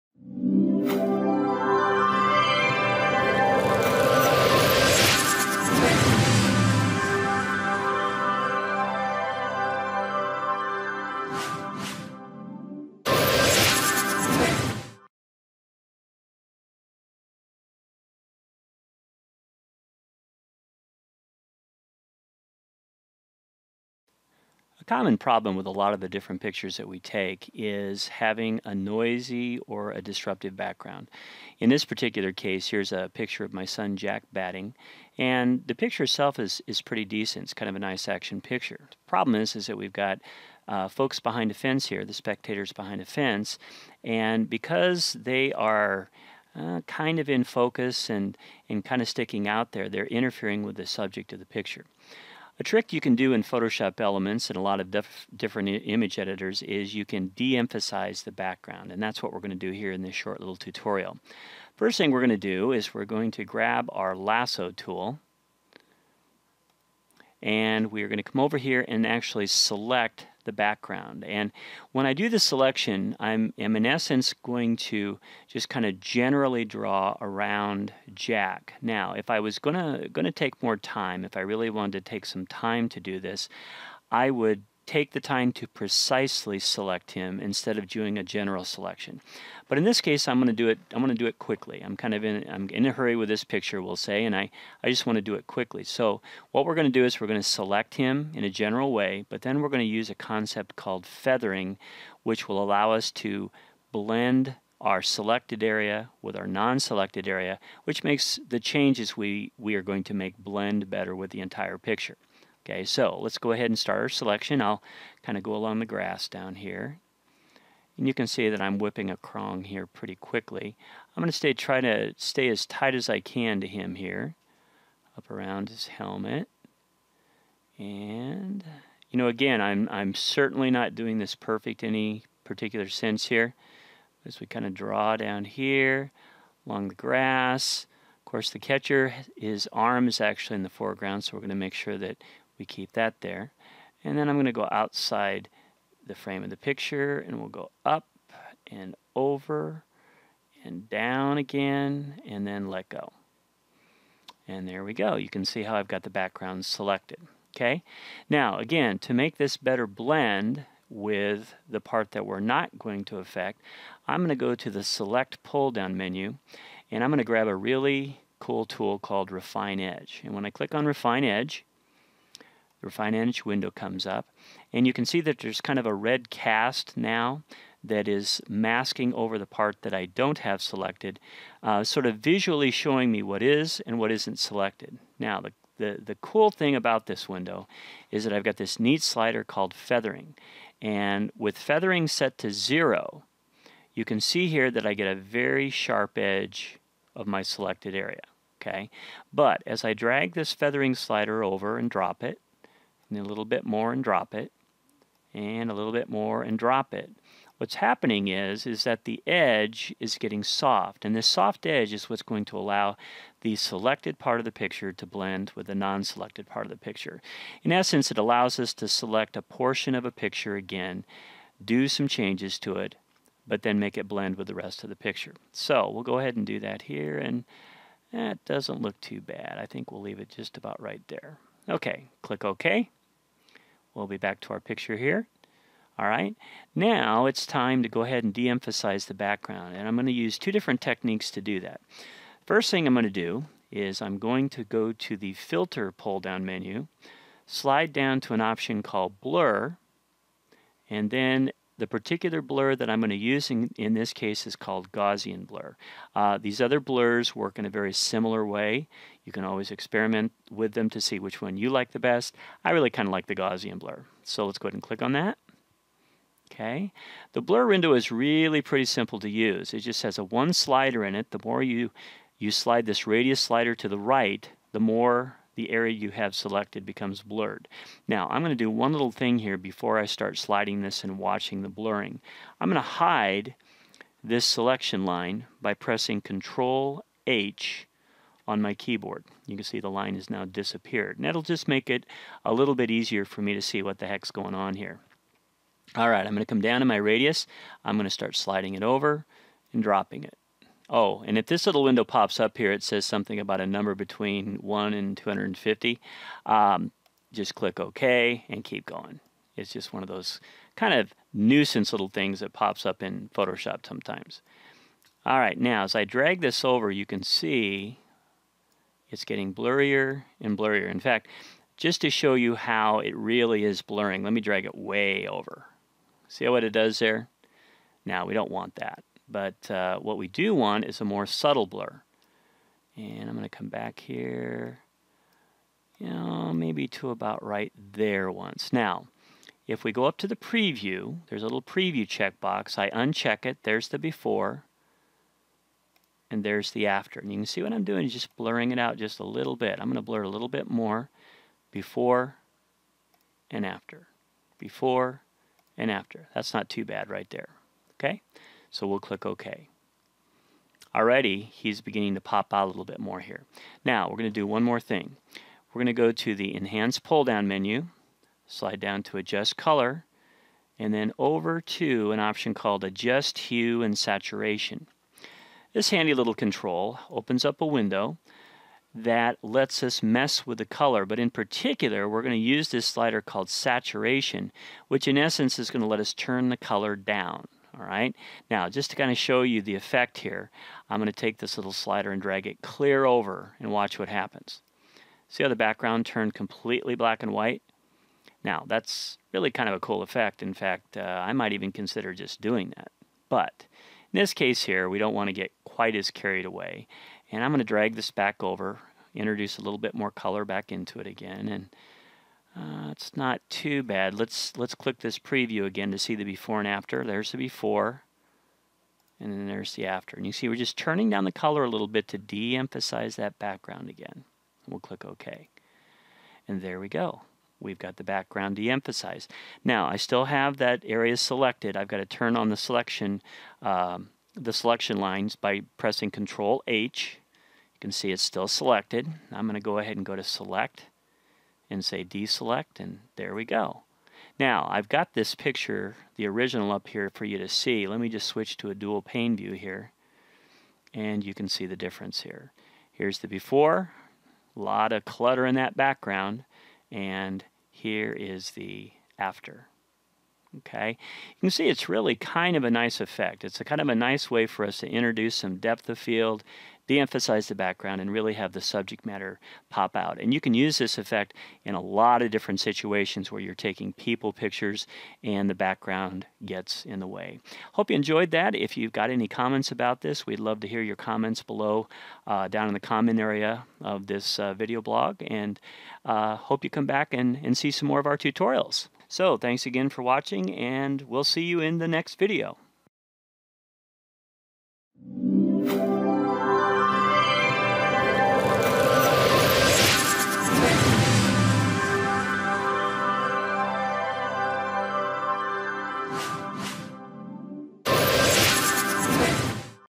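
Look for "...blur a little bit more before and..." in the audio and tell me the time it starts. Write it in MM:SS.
05:50.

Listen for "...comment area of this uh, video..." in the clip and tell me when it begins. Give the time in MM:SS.
08:02.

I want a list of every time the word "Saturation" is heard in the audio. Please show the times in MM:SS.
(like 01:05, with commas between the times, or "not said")
06:13, 06:23.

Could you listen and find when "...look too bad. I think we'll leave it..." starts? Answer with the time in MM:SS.
03:48.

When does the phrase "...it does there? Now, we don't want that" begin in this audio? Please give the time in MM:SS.
05:26.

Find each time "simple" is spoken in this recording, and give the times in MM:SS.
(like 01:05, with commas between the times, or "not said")
04:28.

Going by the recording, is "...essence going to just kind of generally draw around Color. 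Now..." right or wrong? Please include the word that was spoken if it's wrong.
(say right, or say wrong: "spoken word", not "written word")
wrong: "Jack", not "Color".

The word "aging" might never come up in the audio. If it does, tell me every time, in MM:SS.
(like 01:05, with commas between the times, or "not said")
not said.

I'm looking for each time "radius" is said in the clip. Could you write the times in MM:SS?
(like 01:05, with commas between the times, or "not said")
04:33, 04:56.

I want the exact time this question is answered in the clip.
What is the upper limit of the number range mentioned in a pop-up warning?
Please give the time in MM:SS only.
05:05.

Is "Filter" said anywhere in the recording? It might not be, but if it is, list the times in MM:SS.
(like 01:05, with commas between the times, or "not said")
04:05.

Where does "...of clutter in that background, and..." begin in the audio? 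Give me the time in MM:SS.
07:34.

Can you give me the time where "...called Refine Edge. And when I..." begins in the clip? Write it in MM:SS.
02:48.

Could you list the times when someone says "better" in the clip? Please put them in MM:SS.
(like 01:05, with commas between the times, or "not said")
01:50, 02:39.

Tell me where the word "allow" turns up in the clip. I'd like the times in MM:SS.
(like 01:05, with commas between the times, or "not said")
01:42, 03:32, 03:38.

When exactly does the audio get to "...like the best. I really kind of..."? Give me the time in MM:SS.
04:21.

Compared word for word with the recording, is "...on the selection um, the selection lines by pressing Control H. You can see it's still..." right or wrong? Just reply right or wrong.
right.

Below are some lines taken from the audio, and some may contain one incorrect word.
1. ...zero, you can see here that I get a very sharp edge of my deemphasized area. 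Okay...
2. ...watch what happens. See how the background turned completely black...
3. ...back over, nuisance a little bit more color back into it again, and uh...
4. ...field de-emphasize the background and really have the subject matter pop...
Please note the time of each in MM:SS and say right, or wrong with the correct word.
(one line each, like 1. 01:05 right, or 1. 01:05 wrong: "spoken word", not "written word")
1. 03:12 wrong: "selected", not "deemphasized"
2. 06:33 right
3. 06:48 wrong: "introduce", not "nuisance"
4. 07:45 right.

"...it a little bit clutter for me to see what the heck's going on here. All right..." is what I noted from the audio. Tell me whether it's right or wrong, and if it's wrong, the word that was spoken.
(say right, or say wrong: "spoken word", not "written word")
wrong: "easier", not "clutter".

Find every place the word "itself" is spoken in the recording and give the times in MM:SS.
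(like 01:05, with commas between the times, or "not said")
00:36.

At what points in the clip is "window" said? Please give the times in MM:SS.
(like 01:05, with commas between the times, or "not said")
02:53, 03:07, 04:27, 05:01, 06:17.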